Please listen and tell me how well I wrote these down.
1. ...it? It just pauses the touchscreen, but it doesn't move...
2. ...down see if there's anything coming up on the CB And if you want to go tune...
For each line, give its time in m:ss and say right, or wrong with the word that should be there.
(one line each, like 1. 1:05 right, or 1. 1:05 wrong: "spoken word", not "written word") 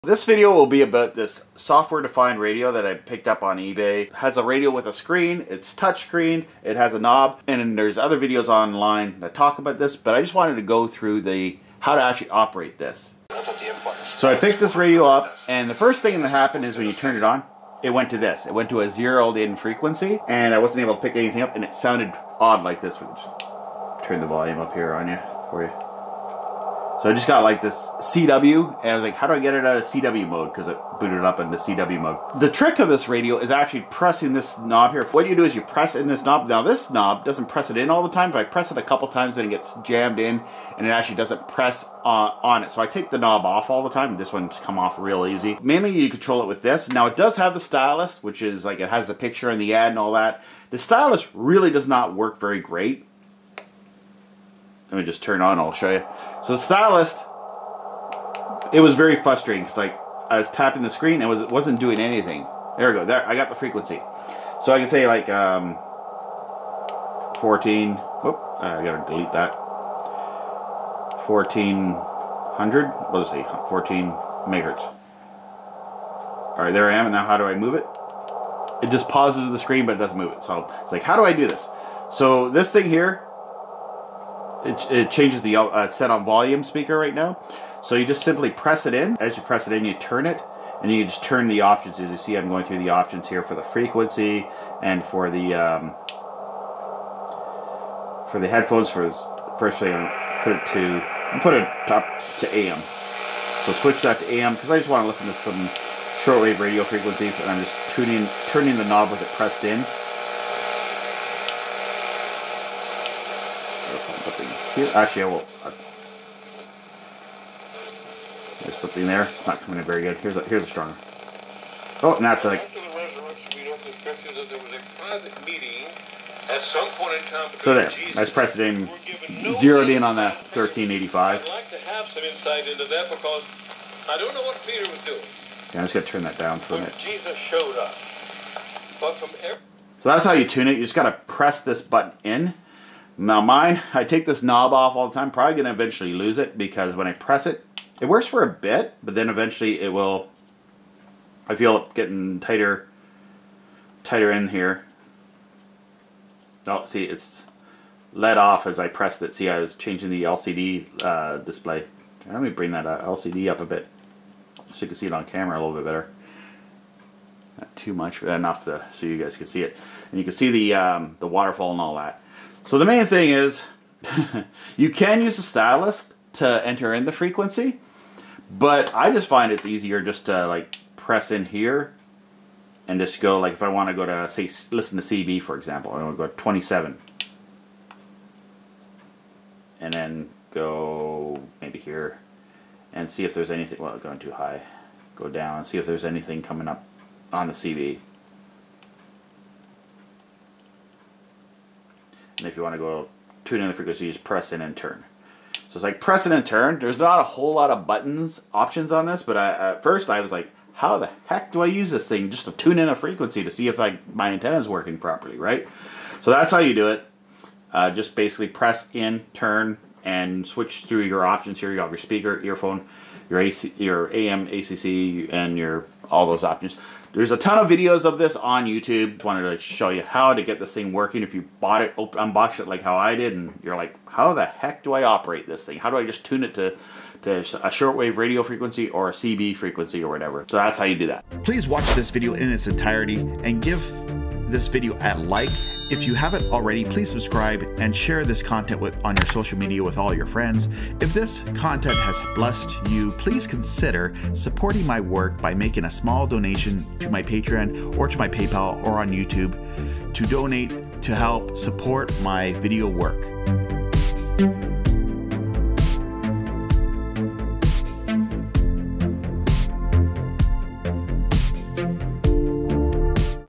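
1. 1:17 wrong: "screen", not "touchscreen"
2. 3:15 right.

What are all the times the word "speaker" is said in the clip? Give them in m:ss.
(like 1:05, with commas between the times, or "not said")
1:26, 3:41.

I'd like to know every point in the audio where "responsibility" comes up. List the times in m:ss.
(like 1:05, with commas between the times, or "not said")
not said.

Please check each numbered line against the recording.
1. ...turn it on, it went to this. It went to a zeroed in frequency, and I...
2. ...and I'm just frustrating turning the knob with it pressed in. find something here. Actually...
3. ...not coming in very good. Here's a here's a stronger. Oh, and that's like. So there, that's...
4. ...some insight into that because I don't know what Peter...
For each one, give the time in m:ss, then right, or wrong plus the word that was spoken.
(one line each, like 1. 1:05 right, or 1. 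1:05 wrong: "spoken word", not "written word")
1. 0:16 right
2. 1:47 wrong: "tuning", not "frustrating"
3. 1:59 right
4. 2:12 right.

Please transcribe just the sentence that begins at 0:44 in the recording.
This one's come off real easy.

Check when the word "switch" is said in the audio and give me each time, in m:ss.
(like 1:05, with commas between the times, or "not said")
1:43, 3:40.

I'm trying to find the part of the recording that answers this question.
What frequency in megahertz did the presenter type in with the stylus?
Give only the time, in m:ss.
1:13.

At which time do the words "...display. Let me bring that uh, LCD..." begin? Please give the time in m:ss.
2:41.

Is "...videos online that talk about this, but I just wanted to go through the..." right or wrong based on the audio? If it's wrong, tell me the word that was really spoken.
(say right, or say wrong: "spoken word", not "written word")
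right.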